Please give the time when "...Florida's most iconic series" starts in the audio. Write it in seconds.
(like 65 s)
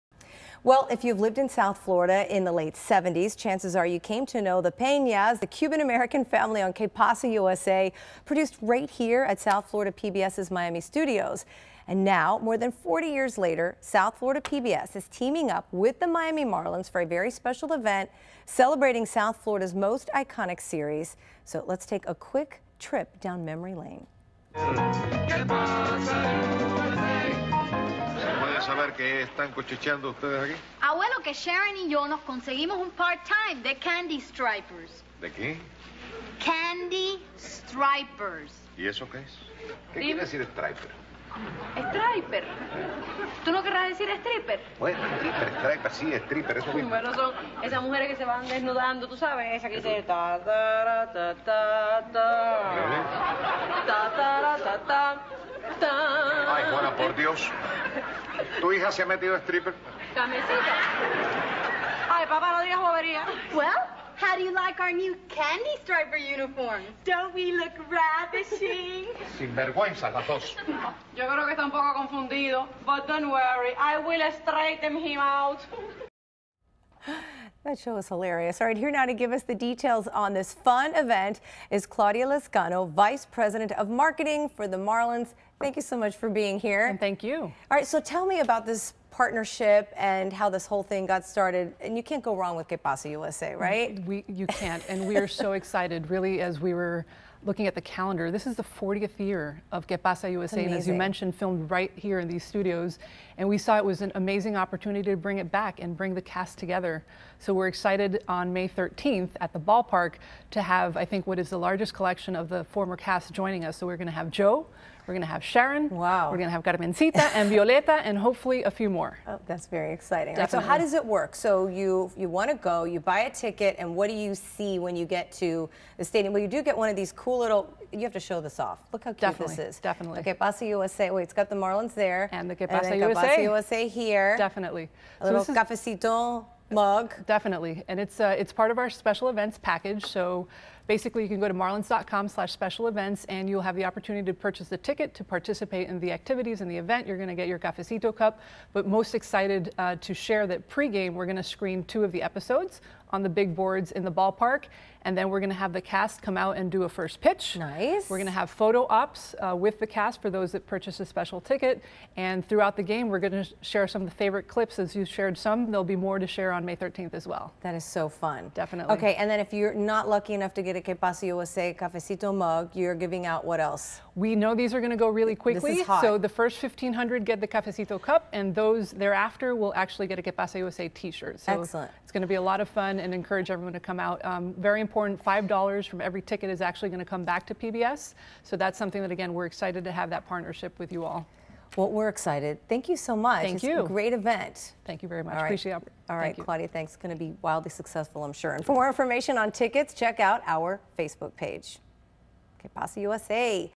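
19 s.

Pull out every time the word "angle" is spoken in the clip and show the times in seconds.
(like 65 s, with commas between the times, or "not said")
not said.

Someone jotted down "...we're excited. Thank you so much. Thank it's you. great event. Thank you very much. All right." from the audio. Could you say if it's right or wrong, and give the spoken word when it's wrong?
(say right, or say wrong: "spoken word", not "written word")
right.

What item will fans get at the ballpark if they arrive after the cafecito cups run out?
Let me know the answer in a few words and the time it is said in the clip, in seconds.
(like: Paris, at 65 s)
T-shirt, at 180 s.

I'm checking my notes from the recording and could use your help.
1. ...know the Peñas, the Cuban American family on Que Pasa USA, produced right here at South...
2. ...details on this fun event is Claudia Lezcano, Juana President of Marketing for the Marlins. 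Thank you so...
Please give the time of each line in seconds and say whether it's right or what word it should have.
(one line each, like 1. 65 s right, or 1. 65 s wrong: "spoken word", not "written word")
1. 4 s right
2. 79 s wrong: "Vice", not "Juana".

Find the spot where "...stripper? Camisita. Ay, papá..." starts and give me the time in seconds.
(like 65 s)
59 s.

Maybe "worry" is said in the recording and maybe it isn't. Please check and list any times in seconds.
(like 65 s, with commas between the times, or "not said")
73 s.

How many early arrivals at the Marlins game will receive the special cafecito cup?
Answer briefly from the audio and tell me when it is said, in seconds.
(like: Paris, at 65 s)
1,500, at 176 s.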